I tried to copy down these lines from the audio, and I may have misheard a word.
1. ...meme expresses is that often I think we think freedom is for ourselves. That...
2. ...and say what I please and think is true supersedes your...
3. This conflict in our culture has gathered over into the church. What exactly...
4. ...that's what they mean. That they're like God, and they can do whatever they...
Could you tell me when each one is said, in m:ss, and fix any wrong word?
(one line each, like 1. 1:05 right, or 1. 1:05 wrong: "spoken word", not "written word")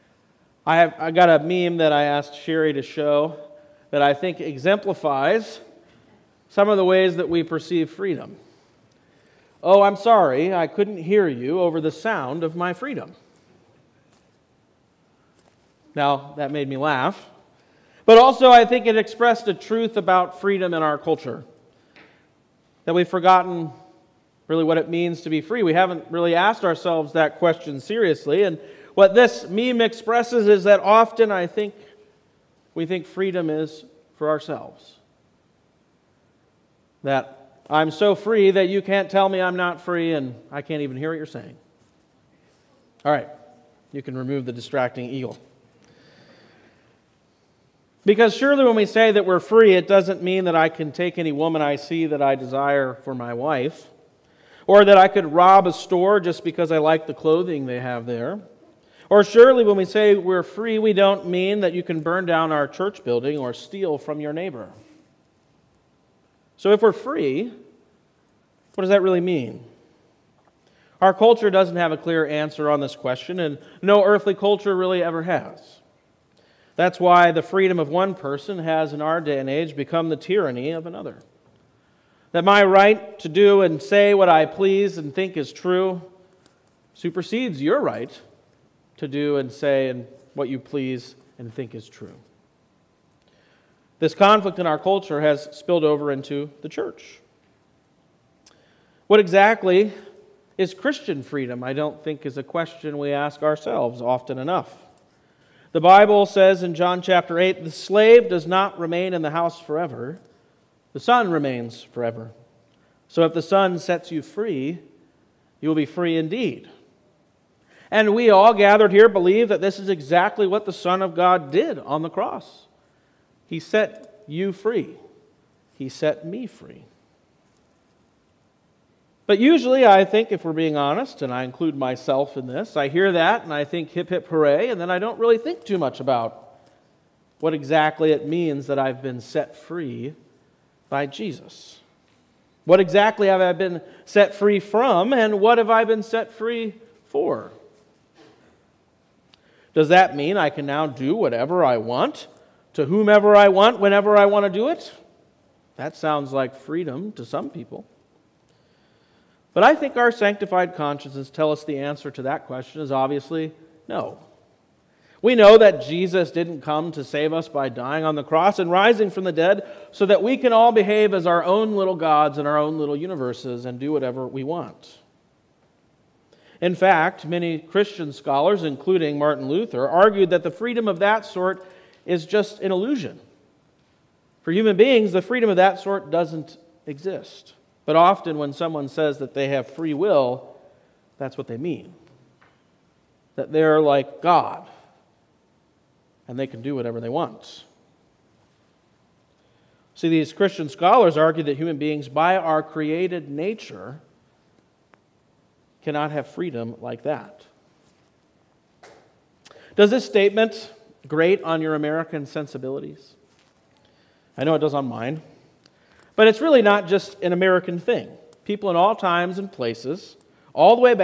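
1. 0:29 right
2. 1:23 right
3. 1:33 wrong: "spilled", not "gathered"
4. 3:11 right.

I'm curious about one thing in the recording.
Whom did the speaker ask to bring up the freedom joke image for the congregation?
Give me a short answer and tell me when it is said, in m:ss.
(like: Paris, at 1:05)
Sherry, at 0:02.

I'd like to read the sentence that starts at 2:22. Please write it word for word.
What exactly have I been set free from, and what have I been set free for?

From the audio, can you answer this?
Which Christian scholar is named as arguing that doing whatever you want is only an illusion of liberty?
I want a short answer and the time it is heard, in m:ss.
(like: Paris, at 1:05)
Martin Luther, at 2:59.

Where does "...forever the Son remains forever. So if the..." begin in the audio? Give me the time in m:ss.
1:49.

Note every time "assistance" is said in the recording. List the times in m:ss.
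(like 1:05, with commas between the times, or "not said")
not said.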